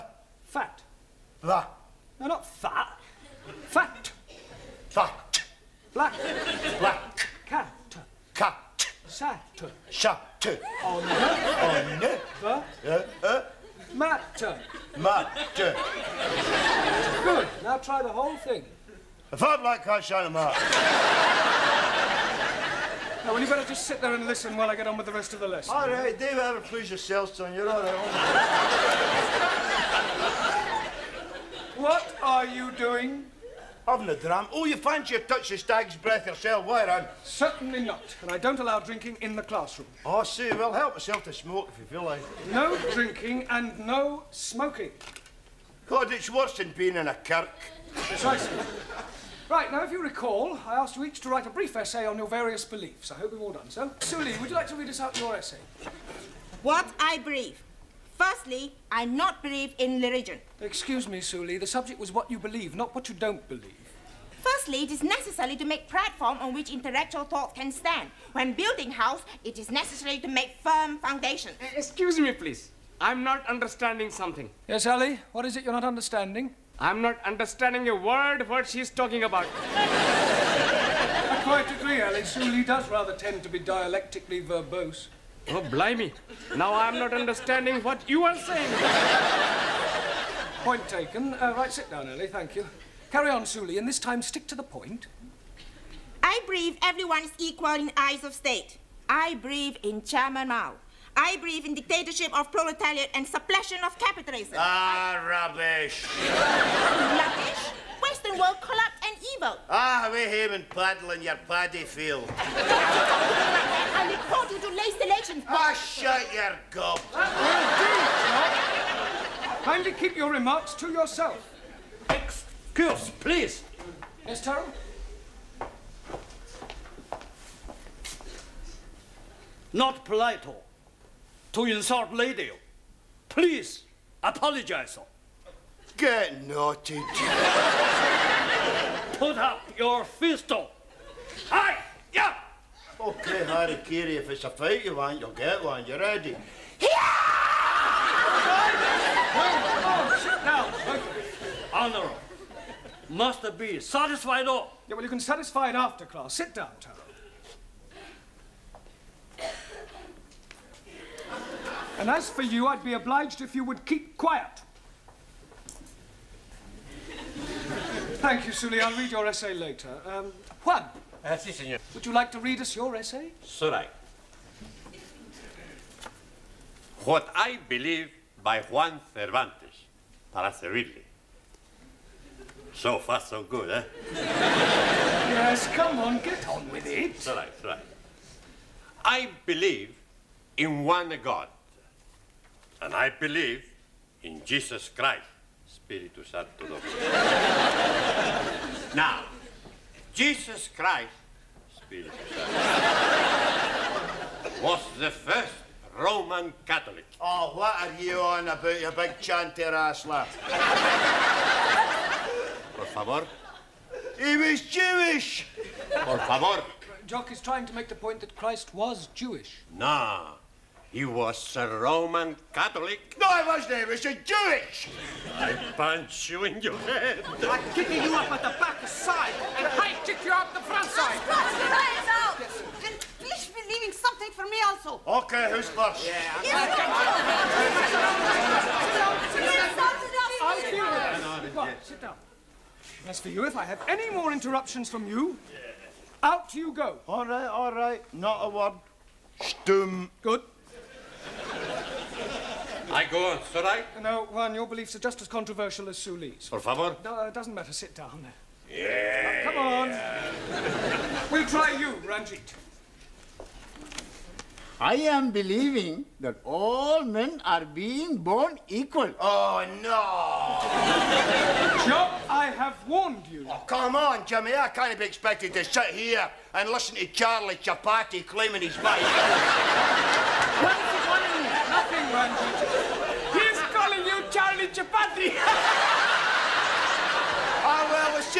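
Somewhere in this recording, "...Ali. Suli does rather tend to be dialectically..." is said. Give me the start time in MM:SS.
01:22.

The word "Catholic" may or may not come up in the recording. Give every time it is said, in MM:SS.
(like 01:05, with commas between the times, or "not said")
03:26, 03:42.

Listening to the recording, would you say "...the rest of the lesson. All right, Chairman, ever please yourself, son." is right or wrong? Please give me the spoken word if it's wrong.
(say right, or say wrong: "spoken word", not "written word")
wrong: "Dave", not "Chairman".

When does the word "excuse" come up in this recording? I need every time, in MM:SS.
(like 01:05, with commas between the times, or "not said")
01:00, 01:11, 02:02.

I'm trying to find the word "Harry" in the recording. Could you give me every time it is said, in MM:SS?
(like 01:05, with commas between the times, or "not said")
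02:23.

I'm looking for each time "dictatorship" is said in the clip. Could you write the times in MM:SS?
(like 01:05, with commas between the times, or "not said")
01:41.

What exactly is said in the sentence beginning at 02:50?
Um, Juan, Ah, sì, Would you like to read us your essay?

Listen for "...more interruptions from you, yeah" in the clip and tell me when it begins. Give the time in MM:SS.
04:04.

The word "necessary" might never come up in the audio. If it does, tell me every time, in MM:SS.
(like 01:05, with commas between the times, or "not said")
01:05, 01:09.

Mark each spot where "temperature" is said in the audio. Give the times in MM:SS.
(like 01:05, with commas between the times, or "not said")
not said.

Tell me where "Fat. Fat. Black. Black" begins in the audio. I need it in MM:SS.
00:03.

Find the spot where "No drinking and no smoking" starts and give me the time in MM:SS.
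00:42.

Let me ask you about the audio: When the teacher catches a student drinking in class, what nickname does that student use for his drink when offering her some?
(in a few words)
stag's breath.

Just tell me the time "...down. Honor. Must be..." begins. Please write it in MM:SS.
02:30.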